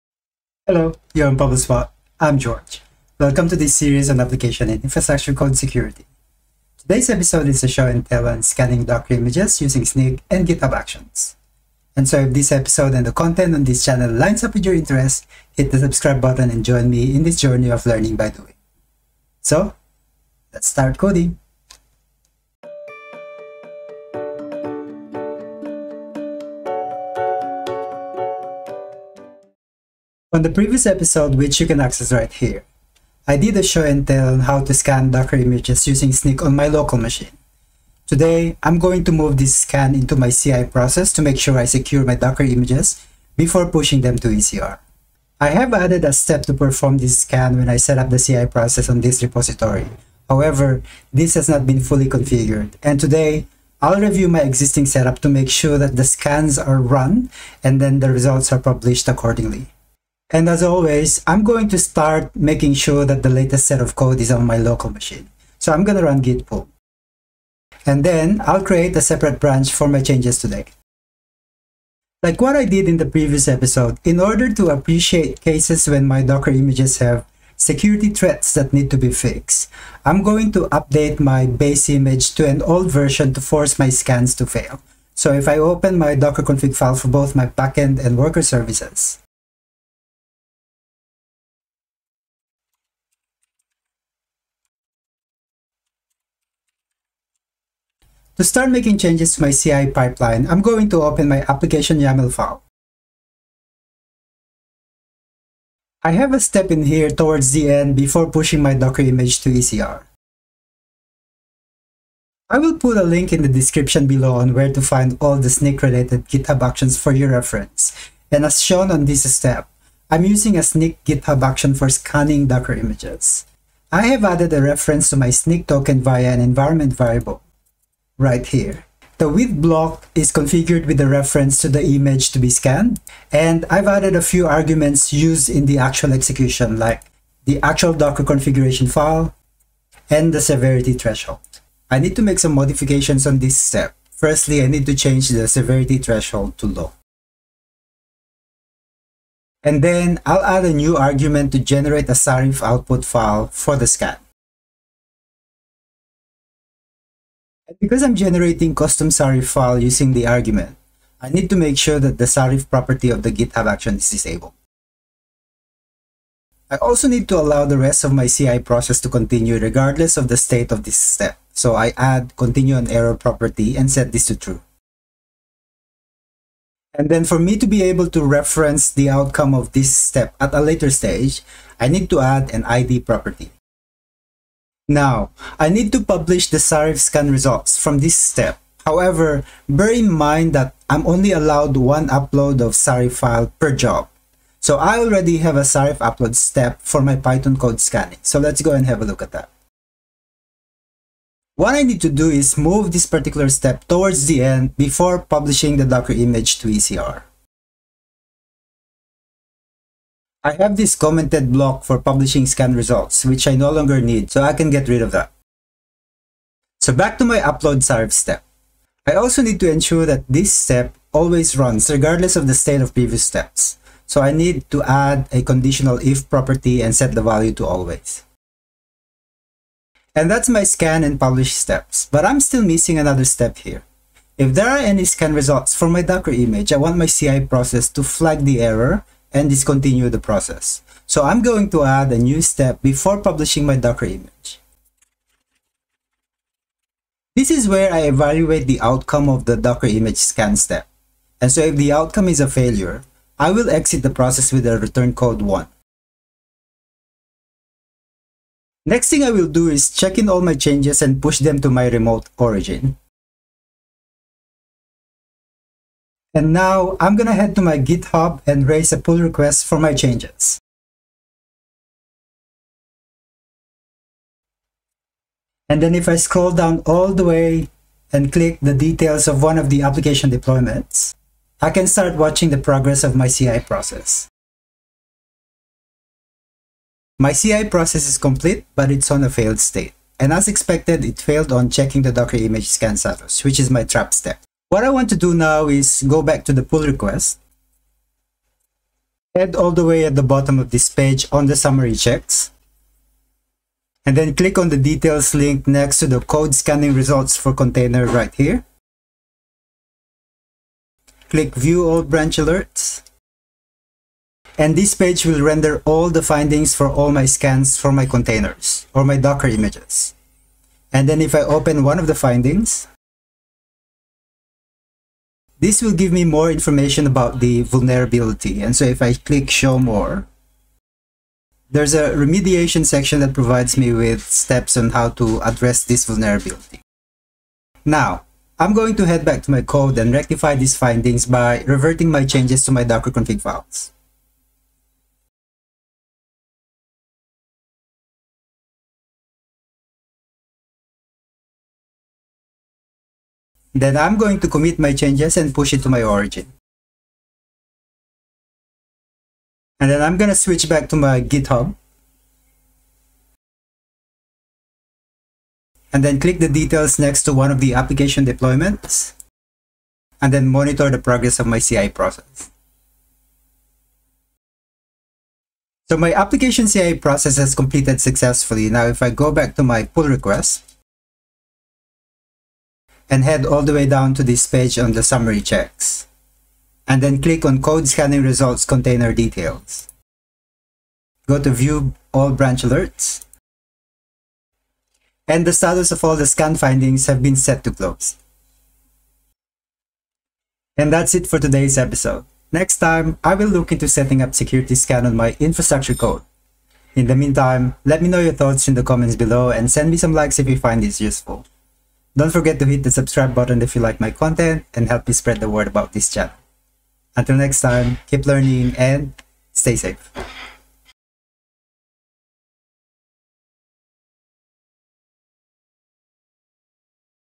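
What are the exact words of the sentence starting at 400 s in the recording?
And that's it for today's episode.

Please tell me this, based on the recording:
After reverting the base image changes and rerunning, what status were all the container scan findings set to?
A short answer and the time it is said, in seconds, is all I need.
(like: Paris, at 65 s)
Closed, at 397 s.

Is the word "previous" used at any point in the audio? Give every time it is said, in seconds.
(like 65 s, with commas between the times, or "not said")
30 s, 73 s, 222 s.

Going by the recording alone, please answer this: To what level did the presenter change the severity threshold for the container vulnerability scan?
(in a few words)
Low.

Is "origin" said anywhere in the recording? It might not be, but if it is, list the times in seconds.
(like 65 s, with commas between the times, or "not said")
262 s, 356 s.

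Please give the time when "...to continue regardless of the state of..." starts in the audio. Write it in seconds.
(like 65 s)
169 s.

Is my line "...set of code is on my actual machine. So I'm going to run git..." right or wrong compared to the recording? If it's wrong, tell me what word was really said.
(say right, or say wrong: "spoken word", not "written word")
wrong: "local", not "actual".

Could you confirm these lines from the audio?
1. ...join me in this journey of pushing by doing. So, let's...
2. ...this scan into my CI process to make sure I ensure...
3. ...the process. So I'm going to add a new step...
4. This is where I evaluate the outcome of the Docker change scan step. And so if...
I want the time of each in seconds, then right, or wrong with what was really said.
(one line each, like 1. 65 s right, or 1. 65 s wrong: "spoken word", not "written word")
1. 16 s wrong: "learning", not "pushing"
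2. 39 s wrong: "secure", not "ensure"
3. 240 s right
4. 247 s wrong: "image", not "change".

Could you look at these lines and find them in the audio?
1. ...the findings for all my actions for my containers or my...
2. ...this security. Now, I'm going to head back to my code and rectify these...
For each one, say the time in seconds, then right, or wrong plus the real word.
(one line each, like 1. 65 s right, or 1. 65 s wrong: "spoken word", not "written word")
1. 316 s wrong: "scans", not "actions"
2. 335 s wrong: "vulnerability", not "security".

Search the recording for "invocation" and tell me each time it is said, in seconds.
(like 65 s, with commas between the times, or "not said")
not said.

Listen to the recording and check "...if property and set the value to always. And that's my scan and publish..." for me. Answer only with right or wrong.
right.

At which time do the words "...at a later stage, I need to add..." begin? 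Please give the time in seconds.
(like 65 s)
180 s.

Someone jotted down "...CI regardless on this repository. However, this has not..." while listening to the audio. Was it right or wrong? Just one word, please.
wrong.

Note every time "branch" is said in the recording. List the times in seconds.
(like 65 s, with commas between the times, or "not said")
69 s, 312 s, 392 s.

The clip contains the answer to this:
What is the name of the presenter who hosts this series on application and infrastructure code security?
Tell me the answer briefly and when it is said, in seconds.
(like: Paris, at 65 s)
George, at 2 s.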